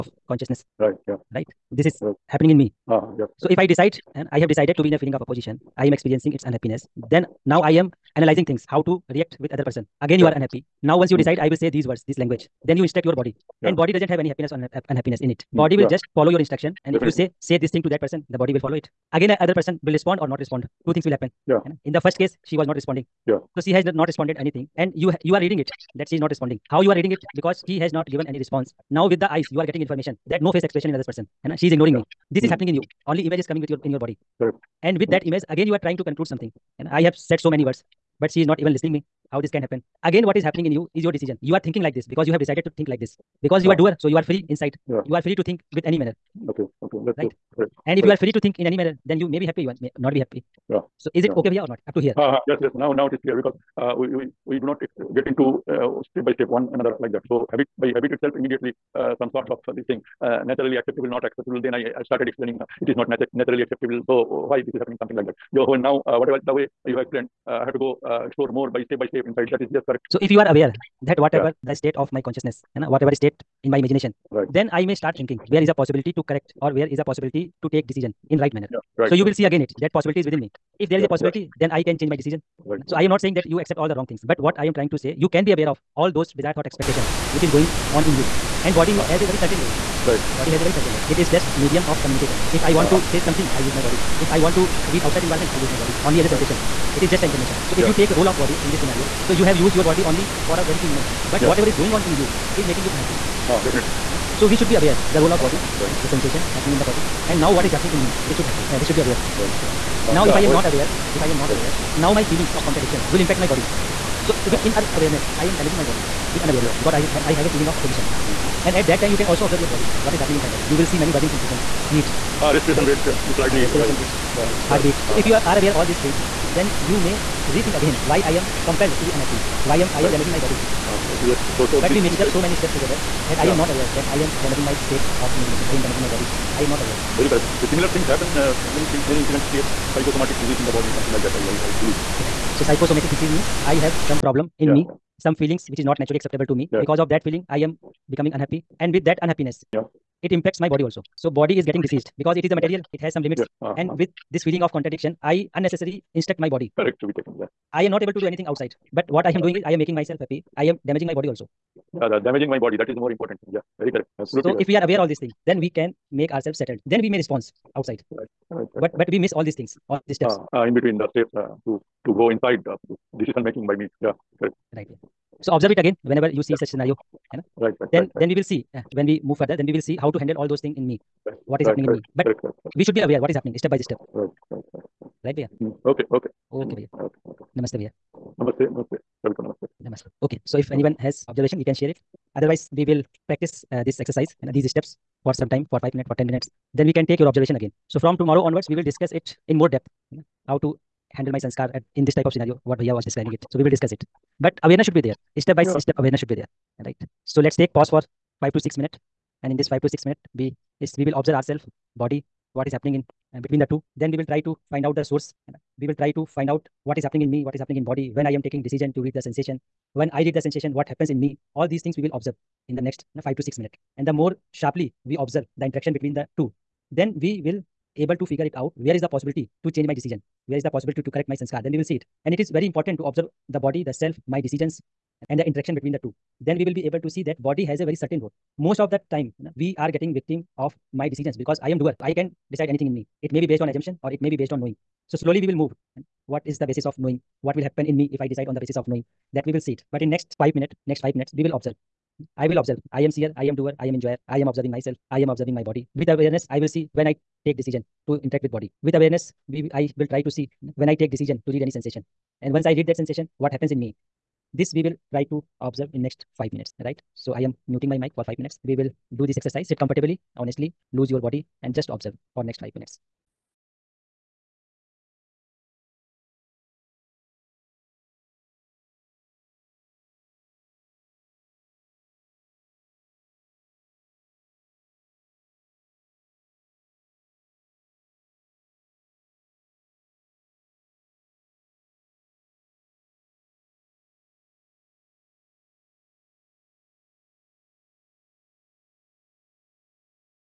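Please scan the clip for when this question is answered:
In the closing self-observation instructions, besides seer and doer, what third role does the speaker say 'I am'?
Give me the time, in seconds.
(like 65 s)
253 s.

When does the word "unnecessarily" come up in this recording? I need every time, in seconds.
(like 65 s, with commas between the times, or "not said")
155 s.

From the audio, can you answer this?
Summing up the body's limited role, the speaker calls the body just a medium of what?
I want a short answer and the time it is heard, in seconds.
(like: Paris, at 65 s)
Communication, at 91 s.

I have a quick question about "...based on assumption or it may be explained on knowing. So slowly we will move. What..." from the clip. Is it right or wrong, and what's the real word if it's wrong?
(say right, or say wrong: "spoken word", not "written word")
wrong: "based", not "explained".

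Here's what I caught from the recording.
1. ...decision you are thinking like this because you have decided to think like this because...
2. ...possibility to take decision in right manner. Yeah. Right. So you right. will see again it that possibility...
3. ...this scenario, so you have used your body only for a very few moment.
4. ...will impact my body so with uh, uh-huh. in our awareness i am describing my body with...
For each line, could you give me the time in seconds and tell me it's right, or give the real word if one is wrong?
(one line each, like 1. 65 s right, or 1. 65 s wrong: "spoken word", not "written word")
1. 41 s right
2. 77 s right
3. 98 s right
4. 113 s wrong: "damaging", not "describing".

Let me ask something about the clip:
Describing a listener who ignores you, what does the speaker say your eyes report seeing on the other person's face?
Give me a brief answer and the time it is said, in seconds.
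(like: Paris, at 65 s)
No face expression, at 30 s.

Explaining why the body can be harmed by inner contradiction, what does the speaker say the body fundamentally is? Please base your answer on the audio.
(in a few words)
A material.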